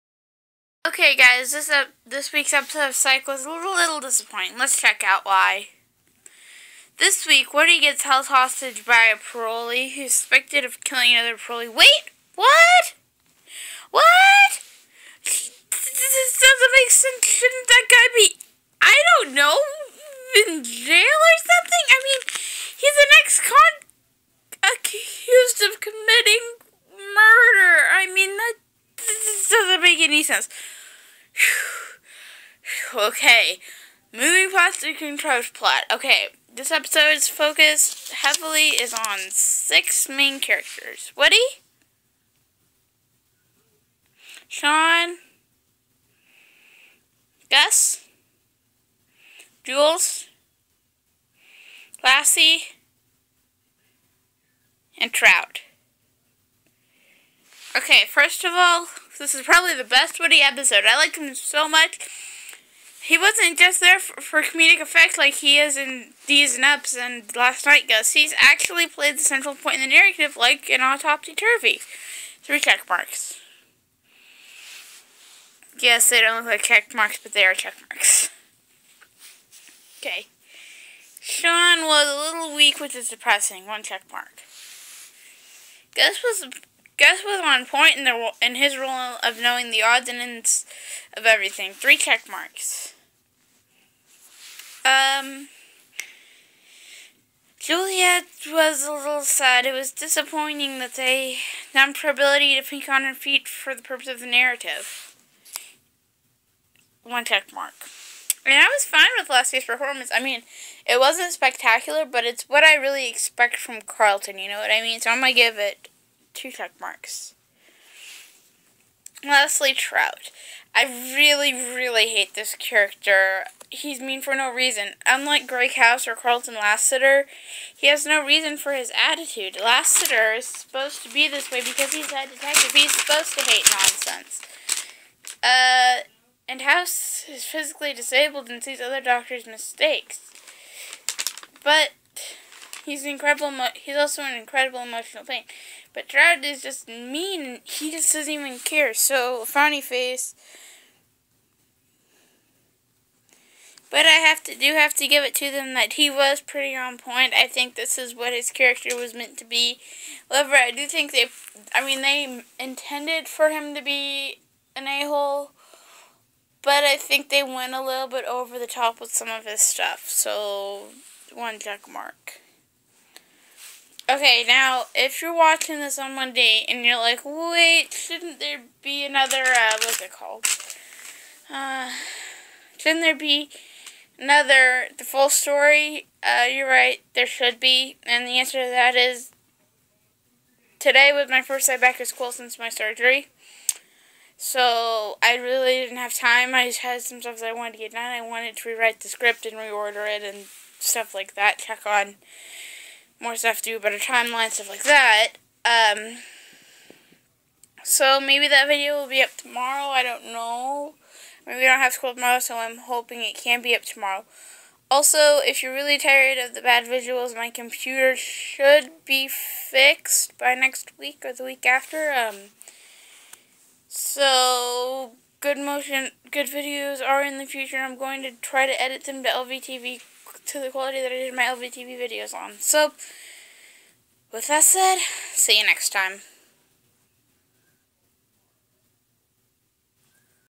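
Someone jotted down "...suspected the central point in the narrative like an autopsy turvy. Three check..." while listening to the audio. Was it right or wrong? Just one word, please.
wrong.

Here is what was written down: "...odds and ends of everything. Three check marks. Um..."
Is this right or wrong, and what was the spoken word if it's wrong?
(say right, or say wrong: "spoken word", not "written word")
right.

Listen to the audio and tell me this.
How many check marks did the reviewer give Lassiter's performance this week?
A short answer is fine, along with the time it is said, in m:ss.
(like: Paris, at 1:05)
2, at 1:56.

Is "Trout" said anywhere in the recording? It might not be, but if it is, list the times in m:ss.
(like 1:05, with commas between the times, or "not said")
0:55, 1:59.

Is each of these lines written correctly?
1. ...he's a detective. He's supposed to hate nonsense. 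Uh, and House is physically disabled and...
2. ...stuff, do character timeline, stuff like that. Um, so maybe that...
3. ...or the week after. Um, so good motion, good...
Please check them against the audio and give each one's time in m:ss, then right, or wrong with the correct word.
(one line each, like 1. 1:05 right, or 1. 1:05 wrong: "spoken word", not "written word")
1. 2:11 right
2. 3:23 wrong: "better", not "character"
3. 3:41 right.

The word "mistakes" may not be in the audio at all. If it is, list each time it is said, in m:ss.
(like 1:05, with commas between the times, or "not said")
2:19.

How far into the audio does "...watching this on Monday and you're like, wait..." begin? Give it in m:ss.
2:55.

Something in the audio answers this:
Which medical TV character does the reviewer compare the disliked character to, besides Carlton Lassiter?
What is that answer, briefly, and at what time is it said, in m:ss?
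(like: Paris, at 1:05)
Greg House, at 2:05.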